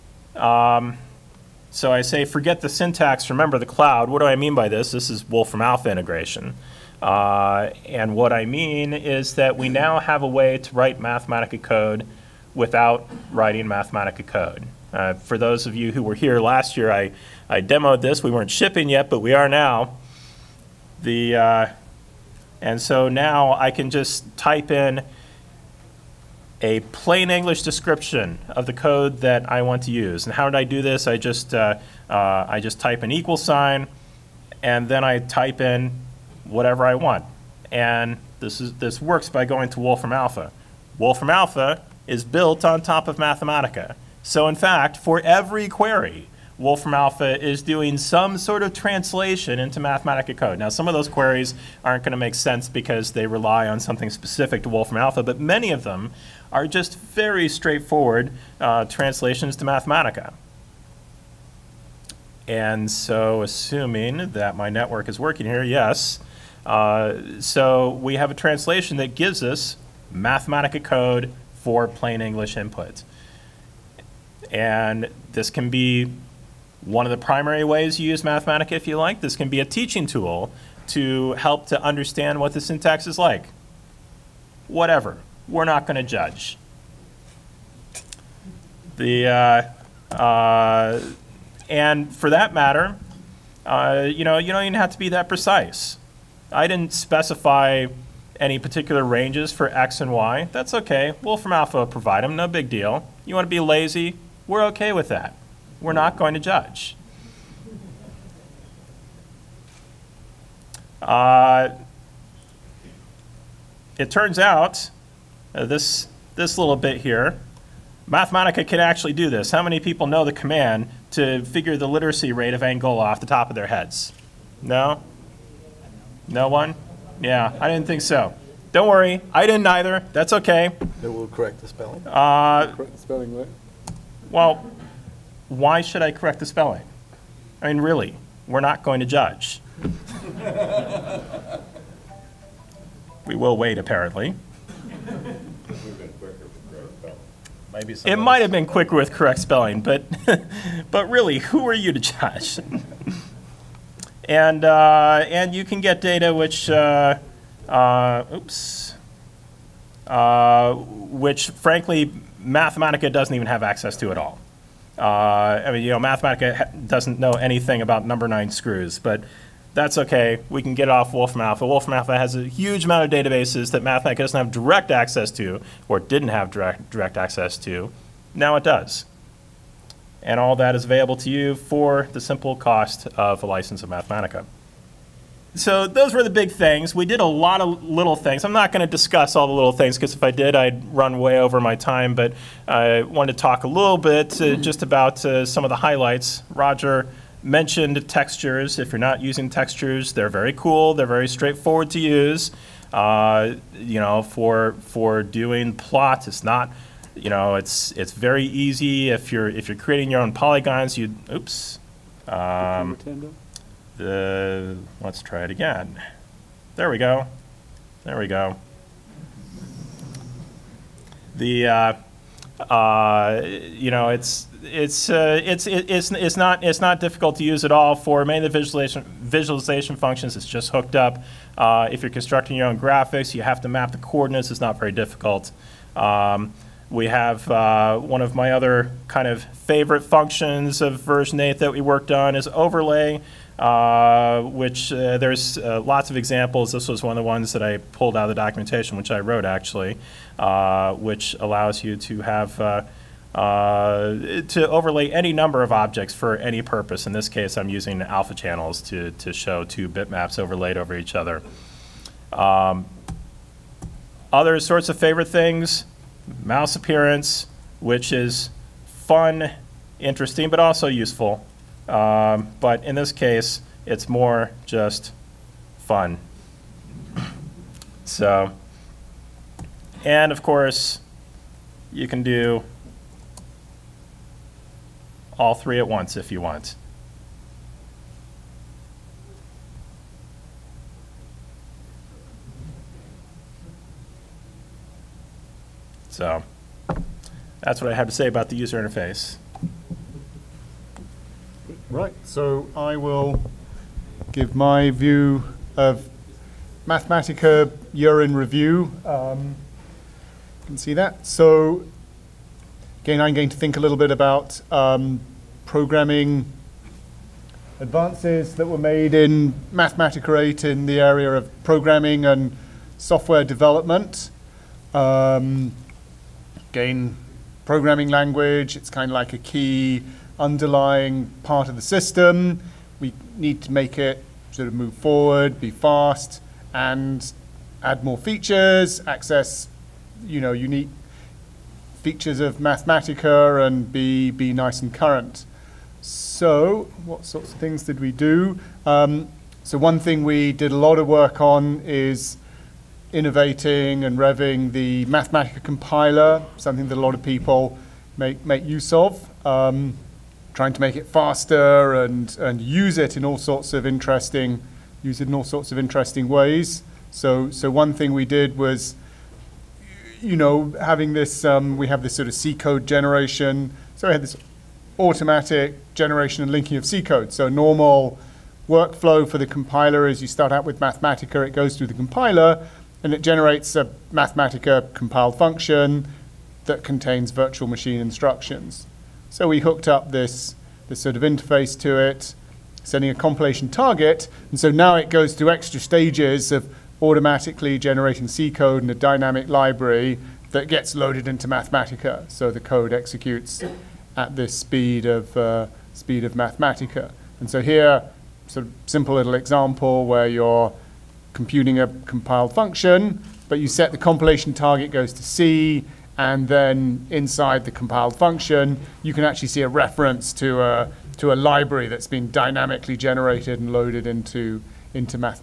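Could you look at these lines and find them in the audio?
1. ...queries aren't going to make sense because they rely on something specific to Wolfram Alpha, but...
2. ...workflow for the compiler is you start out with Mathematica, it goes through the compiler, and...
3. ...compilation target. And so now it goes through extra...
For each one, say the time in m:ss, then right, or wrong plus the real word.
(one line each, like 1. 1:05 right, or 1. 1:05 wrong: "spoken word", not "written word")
1. 0:51 right
2. 6:18 right
3. 6:33 right.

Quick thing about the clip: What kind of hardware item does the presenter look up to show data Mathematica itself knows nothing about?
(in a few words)
number nine screws.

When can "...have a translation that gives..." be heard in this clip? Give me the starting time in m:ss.
1:08.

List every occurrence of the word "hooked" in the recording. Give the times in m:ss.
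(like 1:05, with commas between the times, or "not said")
3:50, 6:29.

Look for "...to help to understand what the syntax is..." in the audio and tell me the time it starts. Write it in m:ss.
1:20.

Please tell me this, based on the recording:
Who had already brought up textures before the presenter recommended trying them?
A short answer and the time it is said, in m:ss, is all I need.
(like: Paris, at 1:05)
Roger, at 3:16.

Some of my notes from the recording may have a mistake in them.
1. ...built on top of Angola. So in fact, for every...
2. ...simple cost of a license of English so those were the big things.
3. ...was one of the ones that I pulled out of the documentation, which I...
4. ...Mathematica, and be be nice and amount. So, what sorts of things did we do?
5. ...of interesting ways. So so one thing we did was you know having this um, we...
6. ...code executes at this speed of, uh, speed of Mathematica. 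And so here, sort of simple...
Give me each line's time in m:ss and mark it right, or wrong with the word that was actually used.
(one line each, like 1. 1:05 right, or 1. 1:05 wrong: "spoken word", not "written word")
1. 0:42 wrong: "Mathematica", not "Angola"
2. 3:02 wrong: "Mathematica", not "English"
3. 4:06 right
4. 5:42 wrong: "current", not "amount"
5. 6:05 right
6. 6:42 right.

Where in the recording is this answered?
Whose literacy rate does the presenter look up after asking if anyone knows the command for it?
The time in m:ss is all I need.
2:02.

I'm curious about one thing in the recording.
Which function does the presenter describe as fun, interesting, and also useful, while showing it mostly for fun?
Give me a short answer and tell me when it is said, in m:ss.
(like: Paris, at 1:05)
mouse appearance, at 4:26.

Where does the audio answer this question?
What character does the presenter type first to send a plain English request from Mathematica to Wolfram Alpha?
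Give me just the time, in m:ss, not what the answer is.
0:33.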